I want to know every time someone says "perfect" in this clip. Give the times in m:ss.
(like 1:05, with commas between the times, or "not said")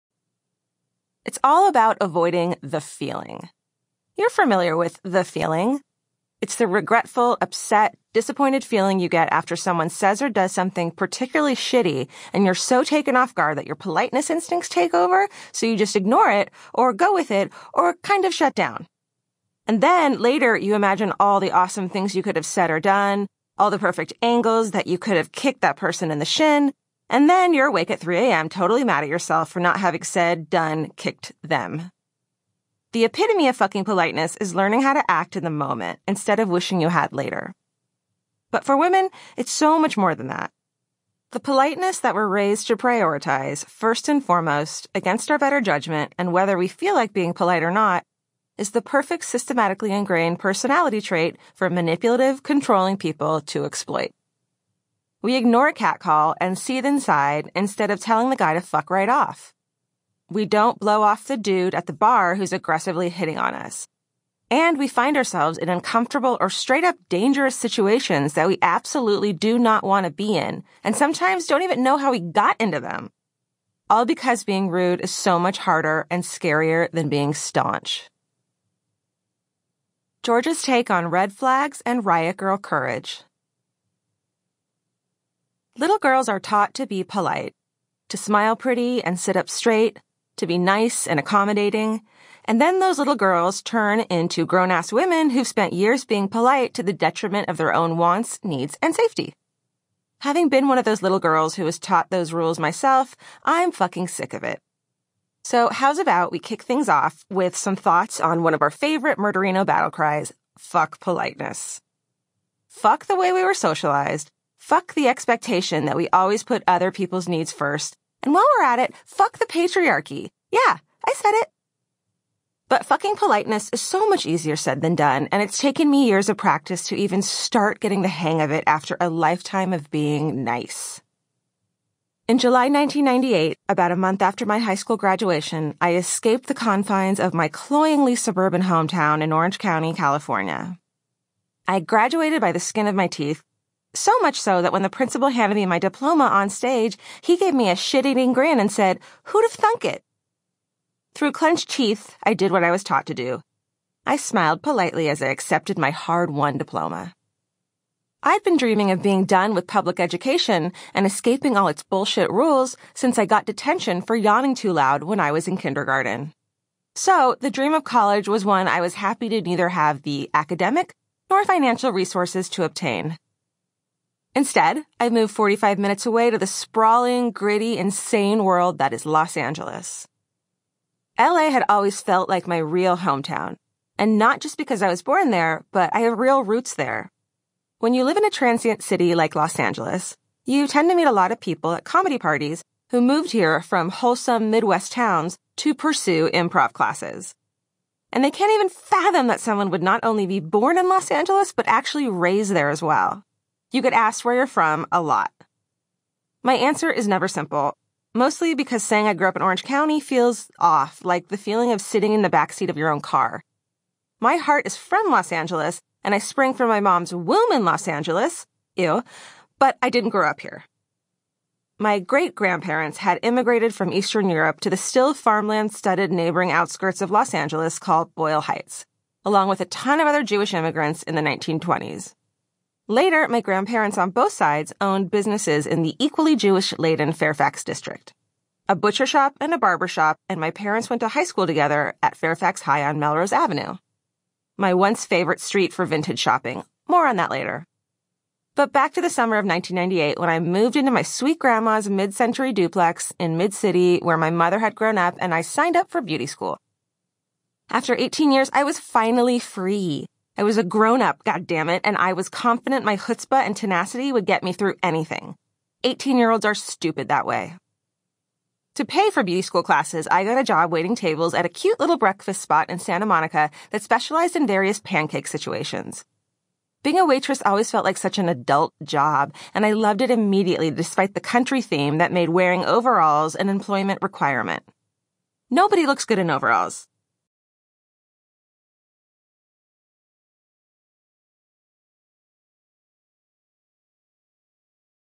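0:23, 0:48.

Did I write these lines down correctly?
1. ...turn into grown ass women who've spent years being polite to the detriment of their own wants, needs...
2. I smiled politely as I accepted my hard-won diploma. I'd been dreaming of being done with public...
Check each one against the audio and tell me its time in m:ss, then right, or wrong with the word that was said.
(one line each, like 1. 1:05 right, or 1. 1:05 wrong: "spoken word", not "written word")
1. 1:33 right
2. 2:34 right.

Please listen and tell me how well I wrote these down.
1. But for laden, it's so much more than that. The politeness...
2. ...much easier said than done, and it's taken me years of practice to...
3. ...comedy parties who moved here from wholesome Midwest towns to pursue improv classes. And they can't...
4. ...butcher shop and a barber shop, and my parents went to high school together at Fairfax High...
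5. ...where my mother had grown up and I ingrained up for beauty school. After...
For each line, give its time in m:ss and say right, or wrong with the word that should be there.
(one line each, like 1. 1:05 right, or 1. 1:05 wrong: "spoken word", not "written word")
1. 0:38 wrong: "women", not "laden"
2. 2:04 right
3. 3:11 right
4. 3:58 right
5. 4:14 wrong: "signed", not "ingrained".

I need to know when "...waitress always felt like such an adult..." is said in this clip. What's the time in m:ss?
4:37.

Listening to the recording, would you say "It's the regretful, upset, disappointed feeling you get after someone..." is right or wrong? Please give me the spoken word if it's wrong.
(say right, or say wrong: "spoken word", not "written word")
right.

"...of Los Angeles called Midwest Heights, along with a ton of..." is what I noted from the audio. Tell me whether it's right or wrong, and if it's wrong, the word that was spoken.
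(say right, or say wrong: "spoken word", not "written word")
wrong: "Boyle", not "Midwest".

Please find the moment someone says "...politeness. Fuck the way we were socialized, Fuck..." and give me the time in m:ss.
1:50.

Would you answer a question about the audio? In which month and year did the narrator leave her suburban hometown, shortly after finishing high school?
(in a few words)
July 1998.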